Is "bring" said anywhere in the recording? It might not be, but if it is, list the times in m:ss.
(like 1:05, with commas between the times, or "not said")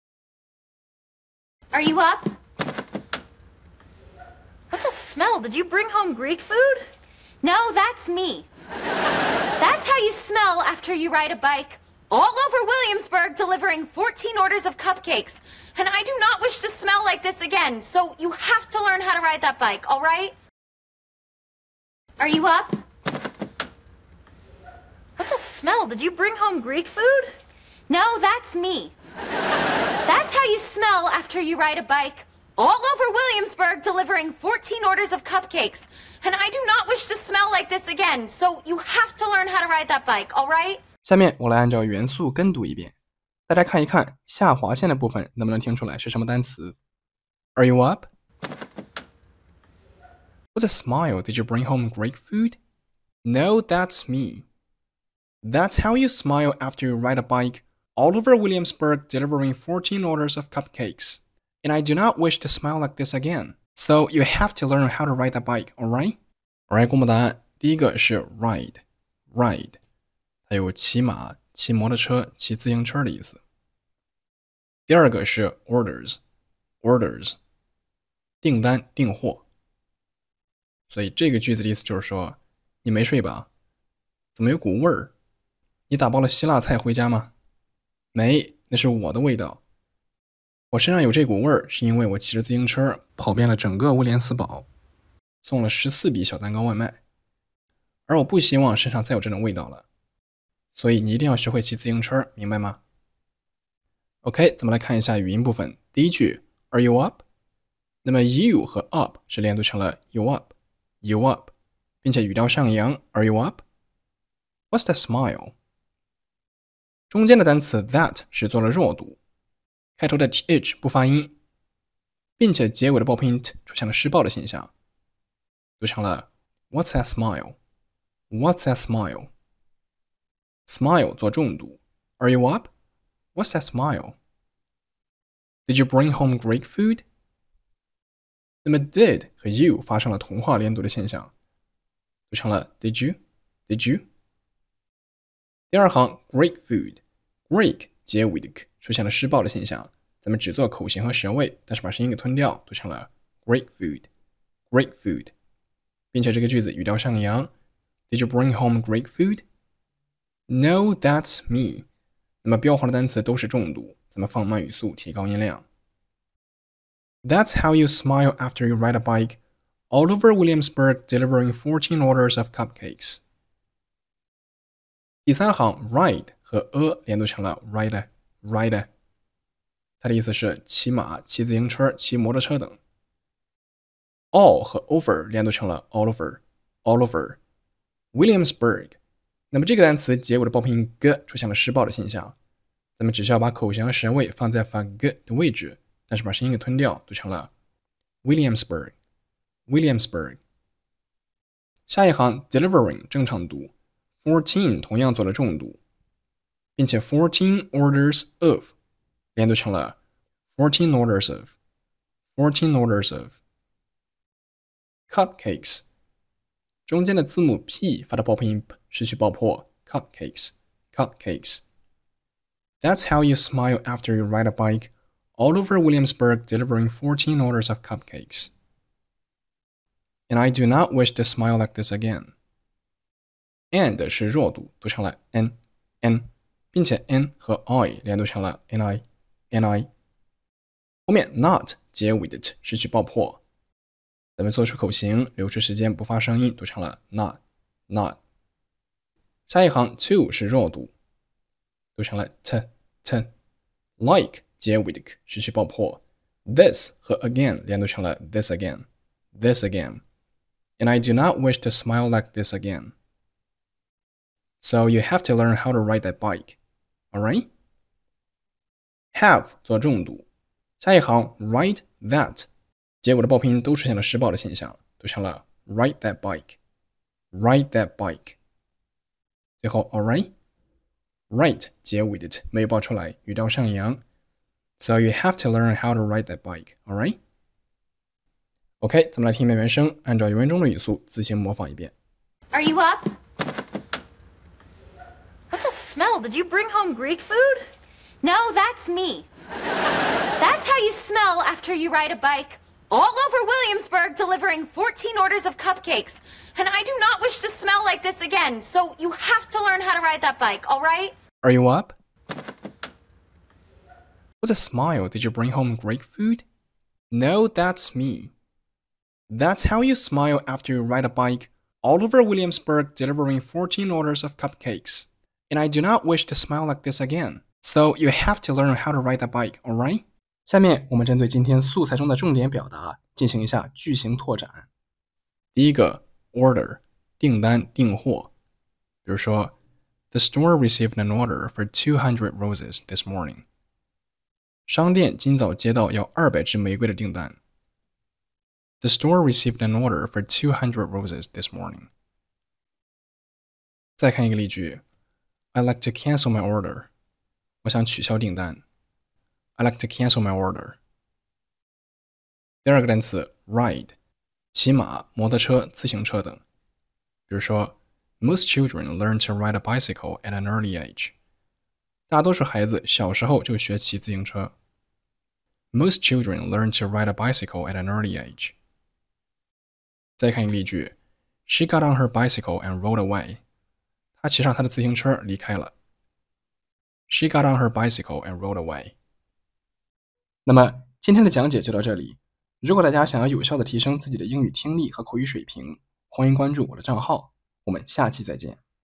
0:05, 0:26, 0:51, 2:15, 2:38, 4:56, 5:15.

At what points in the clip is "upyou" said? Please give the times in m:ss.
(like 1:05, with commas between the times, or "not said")
1:50.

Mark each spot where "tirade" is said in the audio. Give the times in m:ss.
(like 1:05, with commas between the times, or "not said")
not said.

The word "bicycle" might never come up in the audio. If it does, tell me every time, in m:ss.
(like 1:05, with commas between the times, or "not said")
6:09, 6:17, 6:22, 6:27.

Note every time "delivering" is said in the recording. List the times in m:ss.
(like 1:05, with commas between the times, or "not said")
0:13, 0:33, 0:59, 2:51, 3:22, 3:46, 5:04, 5:22.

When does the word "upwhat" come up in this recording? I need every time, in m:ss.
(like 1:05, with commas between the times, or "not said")
1:53.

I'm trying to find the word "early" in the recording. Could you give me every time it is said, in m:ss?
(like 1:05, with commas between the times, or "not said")
6:10, 6:17.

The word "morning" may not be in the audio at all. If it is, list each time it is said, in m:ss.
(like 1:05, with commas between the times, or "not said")
5:43, 5:51.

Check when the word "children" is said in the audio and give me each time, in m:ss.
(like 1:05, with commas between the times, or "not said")
6:08, 6:16.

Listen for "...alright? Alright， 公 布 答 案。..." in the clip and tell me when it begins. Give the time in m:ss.
1:05.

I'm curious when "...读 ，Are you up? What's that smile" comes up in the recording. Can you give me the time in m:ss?
2:11.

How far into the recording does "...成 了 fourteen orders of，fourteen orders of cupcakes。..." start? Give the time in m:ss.
3:29.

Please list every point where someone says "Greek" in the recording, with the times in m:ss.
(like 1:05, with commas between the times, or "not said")
0:06, 0:26, 2:16, 4:56, 5:15.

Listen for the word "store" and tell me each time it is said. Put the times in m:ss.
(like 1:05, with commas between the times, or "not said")
5:40, 5:48.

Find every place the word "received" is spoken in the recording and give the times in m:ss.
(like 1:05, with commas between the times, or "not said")
5:40, 5:49.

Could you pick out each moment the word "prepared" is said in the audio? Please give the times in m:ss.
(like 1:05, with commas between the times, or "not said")
not said.